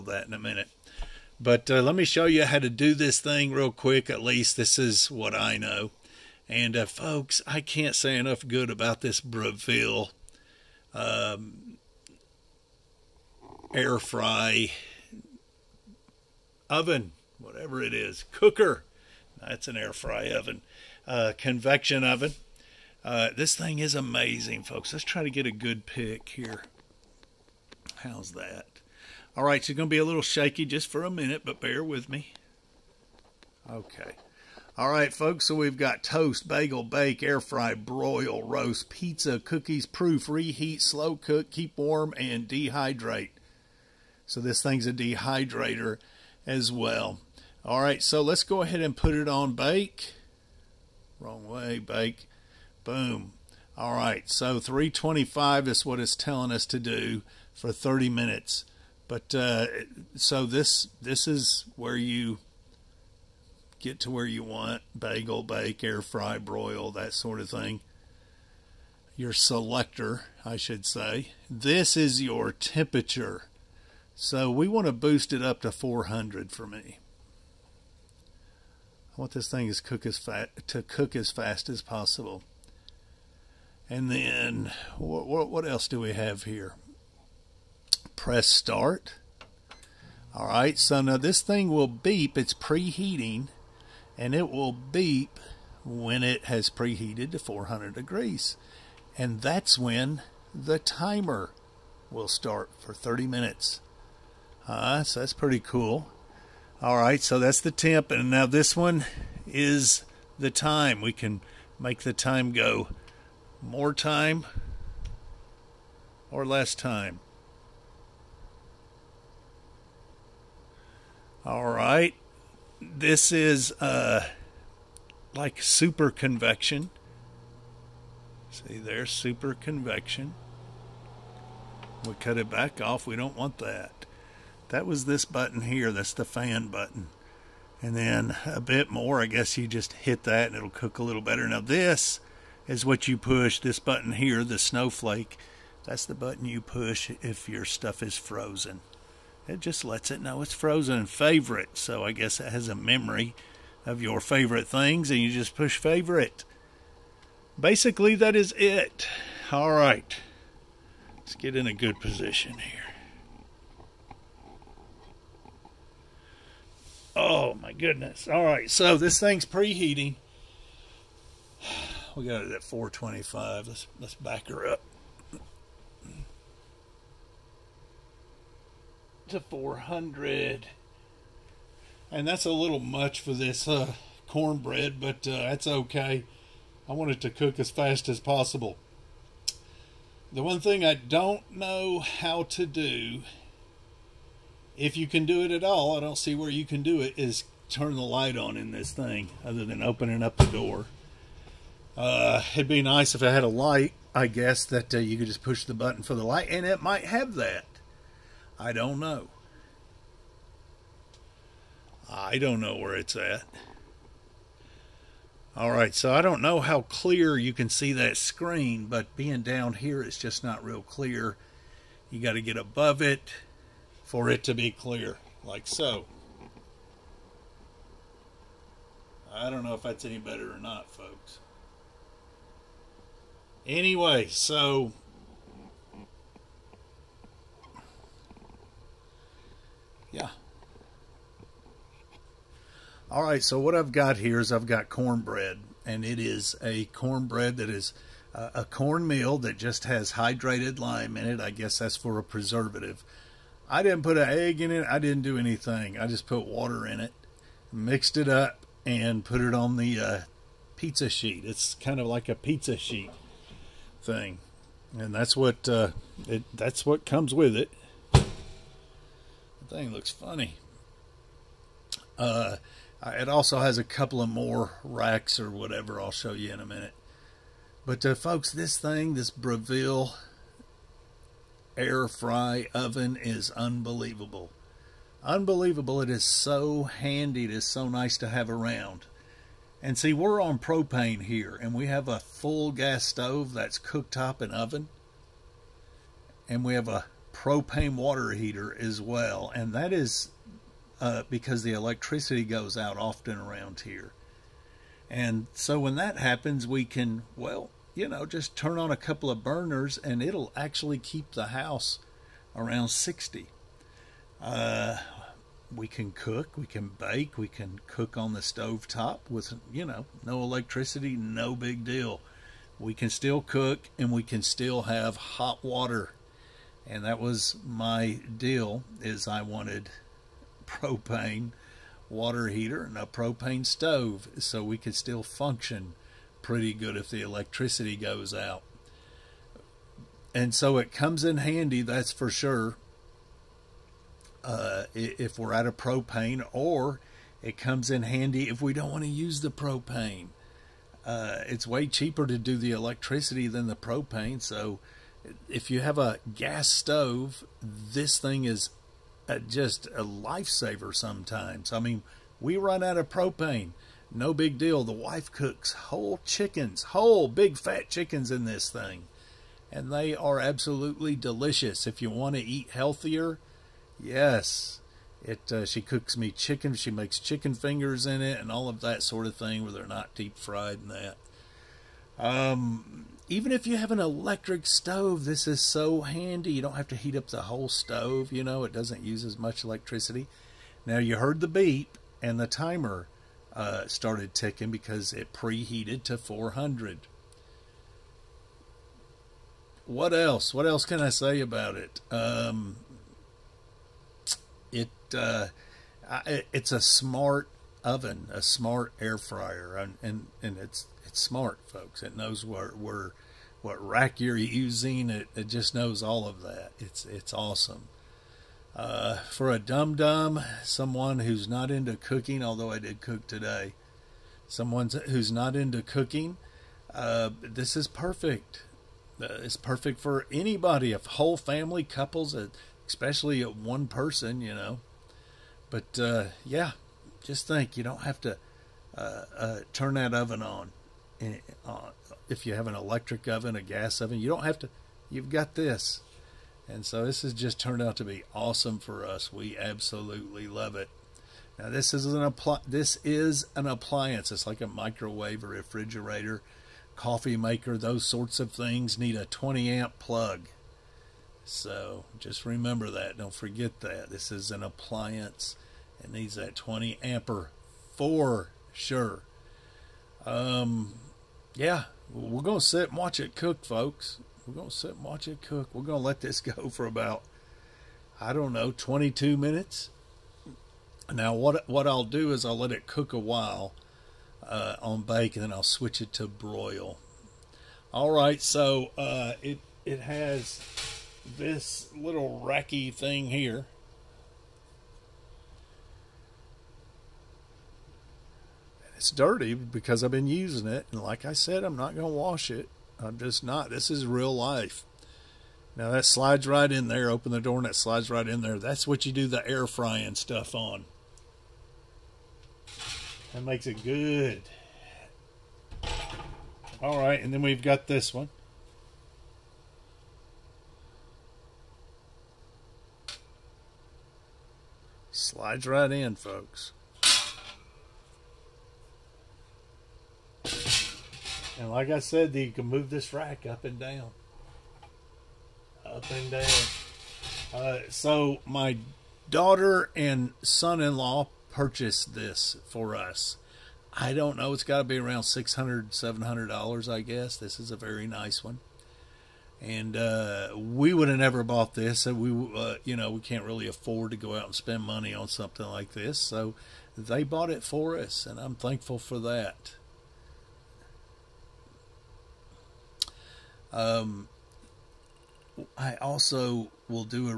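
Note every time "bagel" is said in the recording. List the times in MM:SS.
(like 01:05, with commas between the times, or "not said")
00:36, 01:04.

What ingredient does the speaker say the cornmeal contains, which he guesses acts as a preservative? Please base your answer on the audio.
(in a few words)
hydrated lime.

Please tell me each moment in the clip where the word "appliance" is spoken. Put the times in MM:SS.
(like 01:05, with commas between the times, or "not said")
07:33, 07:44.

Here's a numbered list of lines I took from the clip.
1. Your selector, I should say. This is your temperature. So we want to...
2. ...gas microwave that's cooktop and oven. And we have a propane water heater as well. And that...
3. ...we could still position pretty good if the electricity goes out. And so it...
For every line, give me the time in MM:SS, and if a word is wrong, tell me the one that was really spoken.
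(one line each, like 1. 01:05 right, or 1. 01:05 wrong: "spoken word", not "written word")
1. 01:09 right
2. 04:52 wrong: "stove", not "microwave"
3. 05:34 wrong: "function", not "position".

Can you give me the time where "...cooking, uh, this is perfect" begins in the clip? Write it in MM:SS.
07:05.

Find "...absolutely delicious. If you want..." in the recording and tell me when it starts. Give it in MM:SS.
06:10.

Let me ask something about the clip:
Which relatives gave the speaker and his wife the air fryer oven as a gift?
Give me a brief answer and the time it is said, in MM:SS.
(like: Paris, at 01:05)
daughter and son-in-law, at 08:59.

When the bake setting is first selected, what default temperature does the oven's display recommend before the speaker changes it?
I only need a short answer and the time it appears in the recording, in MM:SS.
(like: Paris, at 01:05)
325, at 00:54.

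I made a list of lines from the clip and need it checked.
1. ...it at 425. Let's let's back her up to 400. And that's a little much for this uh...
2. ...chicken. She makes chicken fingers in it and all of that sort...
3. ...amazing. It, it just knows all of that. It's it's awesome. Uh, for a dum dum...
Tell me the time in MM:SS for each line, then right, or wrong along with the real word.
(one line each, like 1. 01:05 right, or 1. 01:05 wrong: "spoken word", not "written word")
1. 02:52 right
2. 06:16 right
3. 06:54 wrong: "using", not "amazing".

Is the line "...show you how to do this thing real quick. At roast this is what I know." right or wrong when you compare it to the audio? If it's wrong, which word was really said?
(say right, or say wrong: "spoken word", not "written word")
wrong: "least", not "roast".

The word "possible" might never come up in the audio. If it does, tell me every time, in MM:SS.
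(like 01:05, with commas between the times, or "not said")
01:21, 03:08.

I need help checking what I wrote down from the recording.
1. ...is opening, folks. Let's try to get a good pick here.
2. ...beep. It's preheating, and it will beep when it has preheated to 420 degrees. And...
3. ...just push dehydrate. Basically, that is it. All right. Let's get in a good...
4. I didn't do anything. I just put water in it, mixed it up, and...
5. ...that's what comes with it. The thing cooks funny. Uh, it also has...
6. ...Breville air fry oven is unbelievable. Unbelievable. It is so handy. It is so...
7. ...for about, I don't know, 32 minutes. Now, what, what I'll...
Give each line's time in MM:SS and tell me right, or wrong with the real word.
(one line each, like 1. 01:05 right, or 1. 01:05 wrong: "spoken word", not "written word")
1. 00:23 wrong: "amazing", not "opening"
2. 01:31 wrong: "400", not "420"
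3. 02:35 wrong: "favorite", not "dehydrate"
4. 04:14 right
5. 04:26 wrong: "looks", not "cooks"
6. 04:39 right
7. 07:56 wrong: "22", not "32".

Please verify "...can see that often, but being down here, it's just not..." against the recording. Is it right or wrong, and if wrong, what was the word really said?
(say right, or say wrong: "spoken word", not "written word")
wrong: "screen", not "often".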